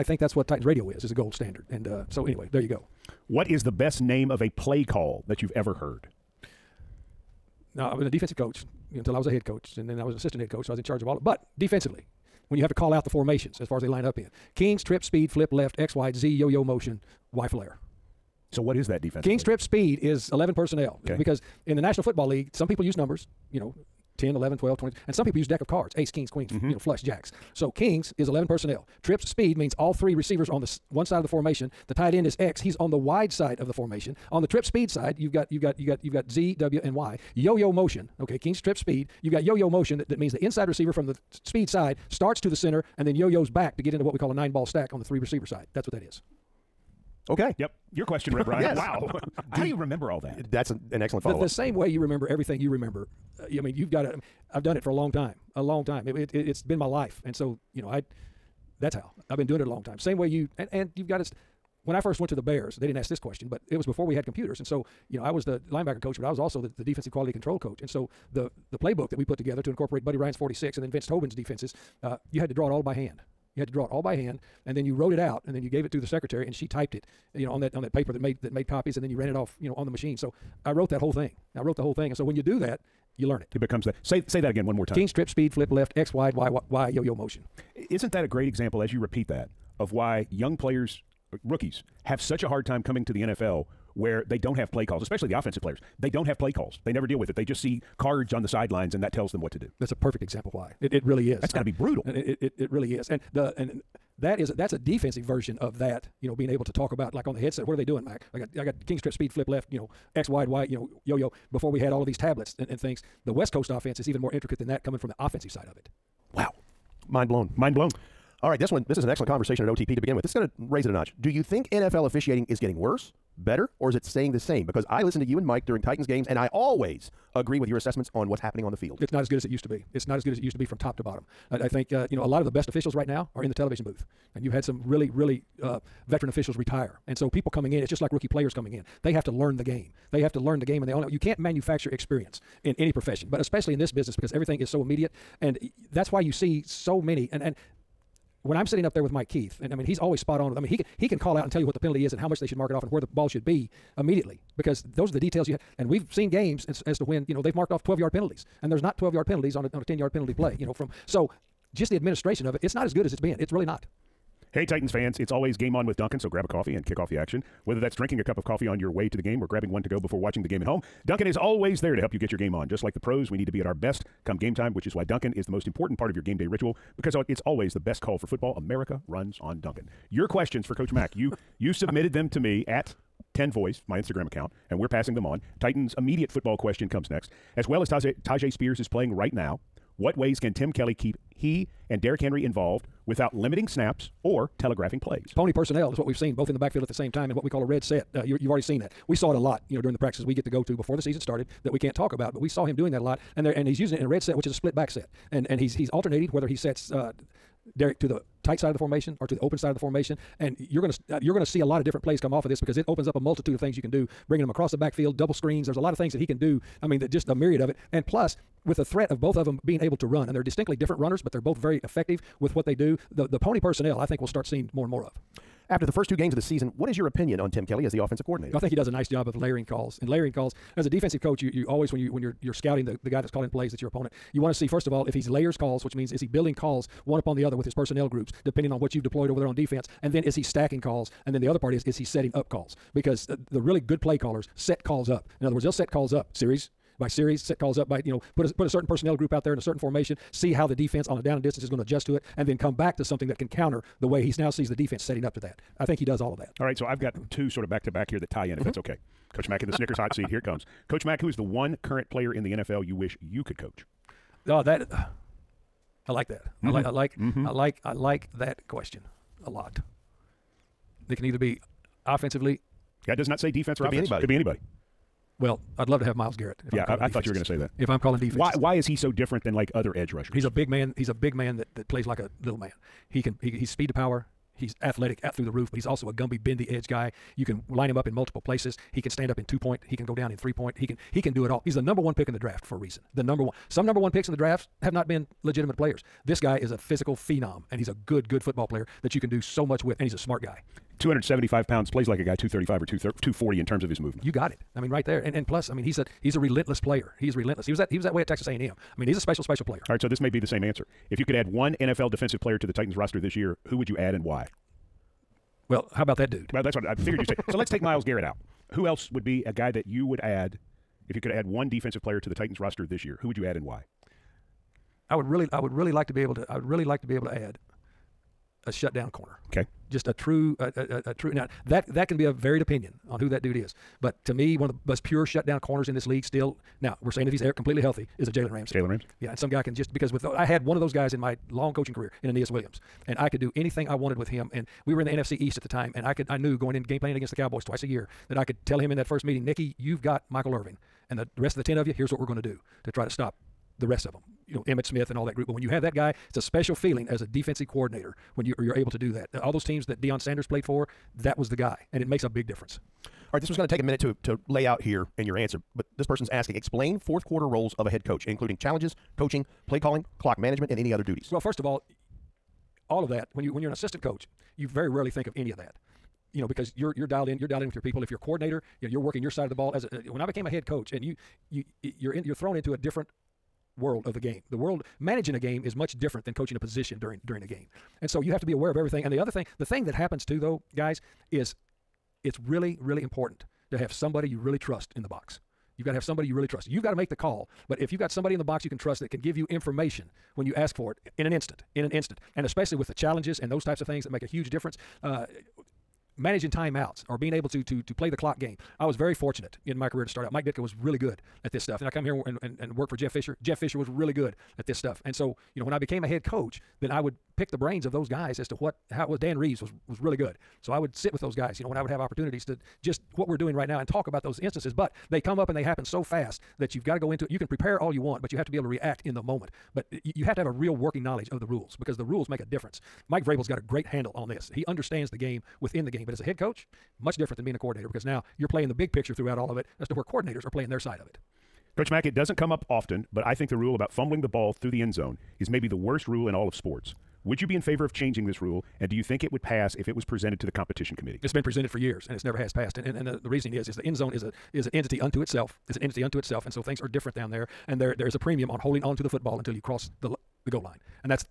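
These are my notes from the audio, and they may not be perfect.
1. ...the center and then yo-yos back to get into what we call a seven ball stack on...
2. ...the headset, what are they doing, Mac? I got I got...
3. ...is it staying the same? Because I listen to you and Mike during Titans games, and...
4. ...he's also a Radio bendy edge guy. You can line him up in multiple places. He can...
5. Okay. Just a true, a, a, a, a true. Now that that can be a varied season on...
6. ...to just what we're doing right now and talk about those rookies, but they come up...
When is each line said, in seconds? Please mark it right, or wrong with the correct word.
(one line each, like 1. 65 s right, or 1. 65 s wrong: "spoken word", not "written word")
1. 42 s wrong: "nine", not "seven"
2. 107 s right
3. 123 s right
4. 285 s wrong: "Gumby", not "Radio"
5. 329 s wrong: "opinion", not "season"
6. 422 s wrong: "instances", not "rookies".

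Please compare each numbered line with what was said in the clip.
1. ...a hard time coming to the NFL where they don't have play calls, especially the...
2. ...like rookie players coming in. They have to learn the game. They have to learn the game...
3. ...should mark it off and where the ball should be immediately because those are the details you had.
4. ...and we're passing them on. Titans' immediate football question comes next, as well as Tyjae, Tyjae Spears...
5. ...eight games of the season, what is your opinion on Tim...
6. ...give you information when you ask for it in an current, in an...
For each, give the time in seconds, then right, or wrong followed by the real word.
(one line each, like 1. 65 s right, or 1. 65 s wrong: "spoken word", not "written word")
1. 92 s right
2. 138 s right
3. 152 s right
4. 184 s right
5. 226 s wrong: "two", not "eight"
6. 399 s wrong: "instant", not "current".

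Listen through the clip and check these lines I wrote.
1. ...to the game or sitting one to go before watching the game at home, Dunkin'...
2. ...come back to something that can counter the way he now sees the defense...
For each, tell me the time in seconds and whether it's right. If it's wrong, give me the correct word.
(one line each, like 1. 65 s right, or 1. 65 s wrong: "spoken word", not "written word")
1. 169 s wrong: "grabbing", not "sitting"
2. 252 s right.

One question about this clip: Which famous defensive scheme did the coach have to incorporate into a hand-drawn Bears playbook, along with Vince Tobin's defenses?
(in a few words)
Buddy Ryan's 46.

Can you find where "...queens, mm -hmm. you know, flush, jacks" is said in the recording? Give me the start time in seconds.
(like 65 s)
26 s.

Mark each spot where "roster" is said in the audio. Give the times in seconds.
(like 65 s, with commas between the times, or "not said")
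312 s, 322 s.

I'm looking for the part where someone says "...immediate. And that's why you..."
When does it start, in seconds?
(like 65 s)
144 s.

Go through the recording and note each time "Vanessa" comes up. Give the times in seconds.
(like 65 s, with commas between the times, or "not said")
not said.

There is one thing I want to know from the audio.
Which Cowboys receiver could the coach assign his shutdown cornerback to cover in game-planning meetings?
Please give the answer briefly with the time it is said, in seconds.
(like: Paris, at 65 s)
Michael Irvin, at 350 s.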